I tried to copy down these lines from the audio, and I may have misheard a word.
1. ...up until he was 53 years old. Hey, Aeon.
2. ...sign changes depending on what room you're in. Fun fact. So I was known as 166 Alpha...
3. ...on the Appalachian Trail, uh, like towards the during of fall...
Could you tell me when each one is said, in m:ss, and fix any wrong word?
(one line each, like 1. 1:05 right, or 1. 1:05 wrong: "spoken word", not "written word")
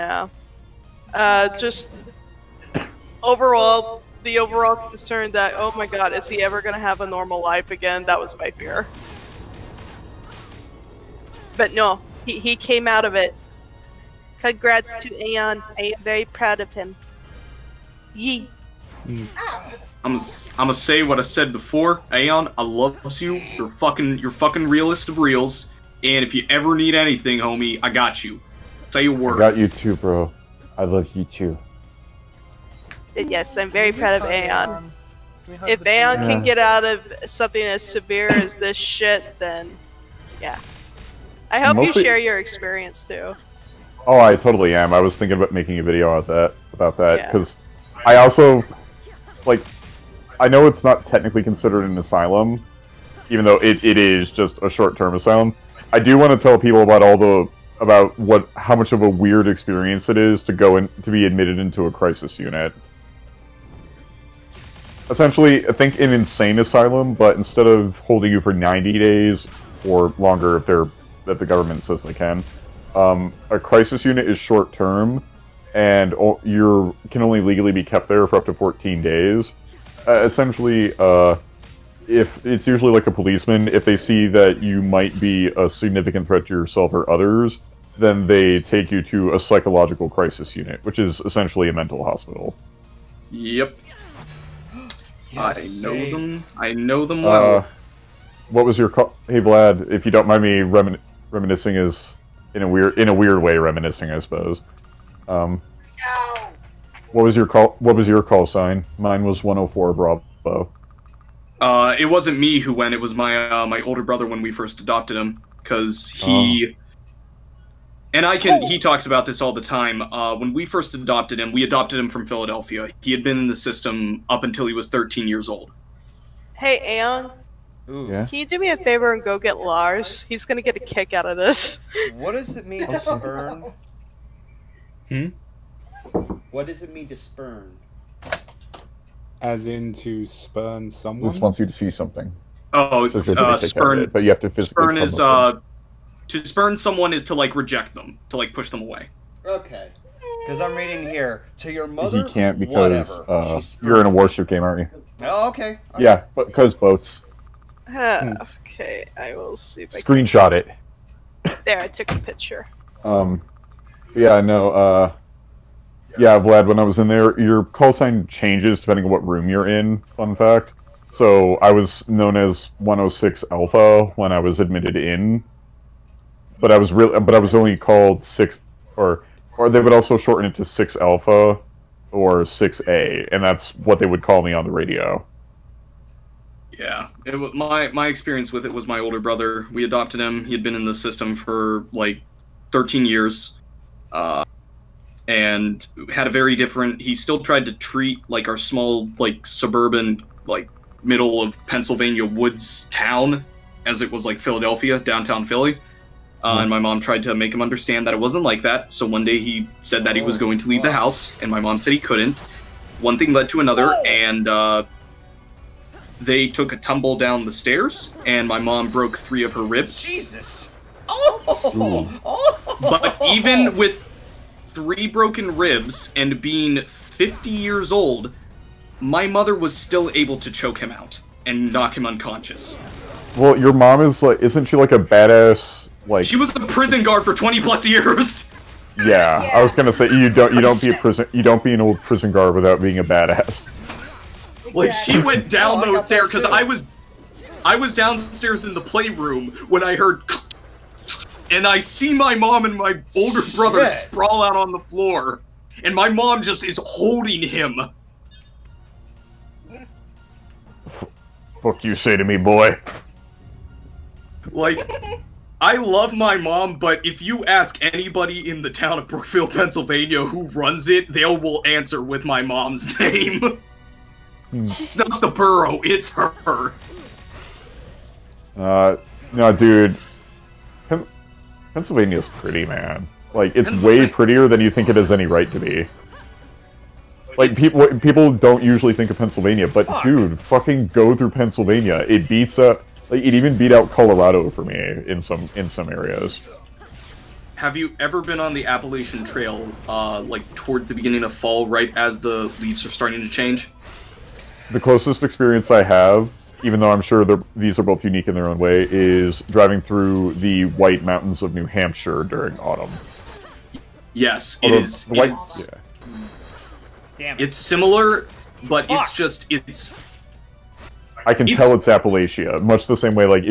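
1. 2:04 wrong: "13", not "53"
2. 2:47 wrong: "106", not "166"
3. 4:58 wrong: "beginning", not "during".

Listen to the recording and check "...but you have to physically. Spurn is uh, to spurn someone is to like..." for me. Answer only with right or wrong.
right.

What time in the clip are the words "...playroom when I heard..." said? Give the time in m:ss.
4:08.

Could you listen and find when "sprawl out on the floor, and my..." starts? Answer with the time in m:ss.
4:13.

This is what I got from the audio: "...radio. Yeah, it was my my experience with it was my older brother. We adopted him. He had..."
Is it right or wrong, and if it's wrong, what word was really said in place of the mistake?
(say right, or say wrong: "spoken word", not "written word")
right.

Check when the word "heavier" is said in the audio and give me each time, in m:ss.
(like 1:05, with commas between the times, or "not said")
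not said.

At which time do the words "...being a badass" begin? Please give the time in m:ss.
4:02.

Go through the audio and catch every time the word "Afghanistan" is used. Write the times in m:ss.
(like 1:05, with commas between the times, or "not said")
not said.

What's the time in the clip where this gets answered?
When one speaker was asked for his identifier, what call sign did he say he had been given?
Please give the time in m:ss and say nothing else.
1:49.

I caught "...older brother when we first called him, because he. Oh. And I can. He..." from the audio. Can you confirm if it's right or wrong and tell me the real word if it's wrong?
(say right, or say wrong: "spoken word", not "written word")
wrong: "adopted", not "called".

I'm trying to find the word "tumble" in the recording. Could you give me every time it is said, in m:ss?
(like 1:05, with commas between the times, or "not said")
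3:36.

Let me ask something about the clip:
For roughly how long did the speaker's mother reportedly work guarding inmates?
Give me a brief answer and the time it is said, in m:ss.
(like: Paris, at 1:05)
20 plus years, at 3:57.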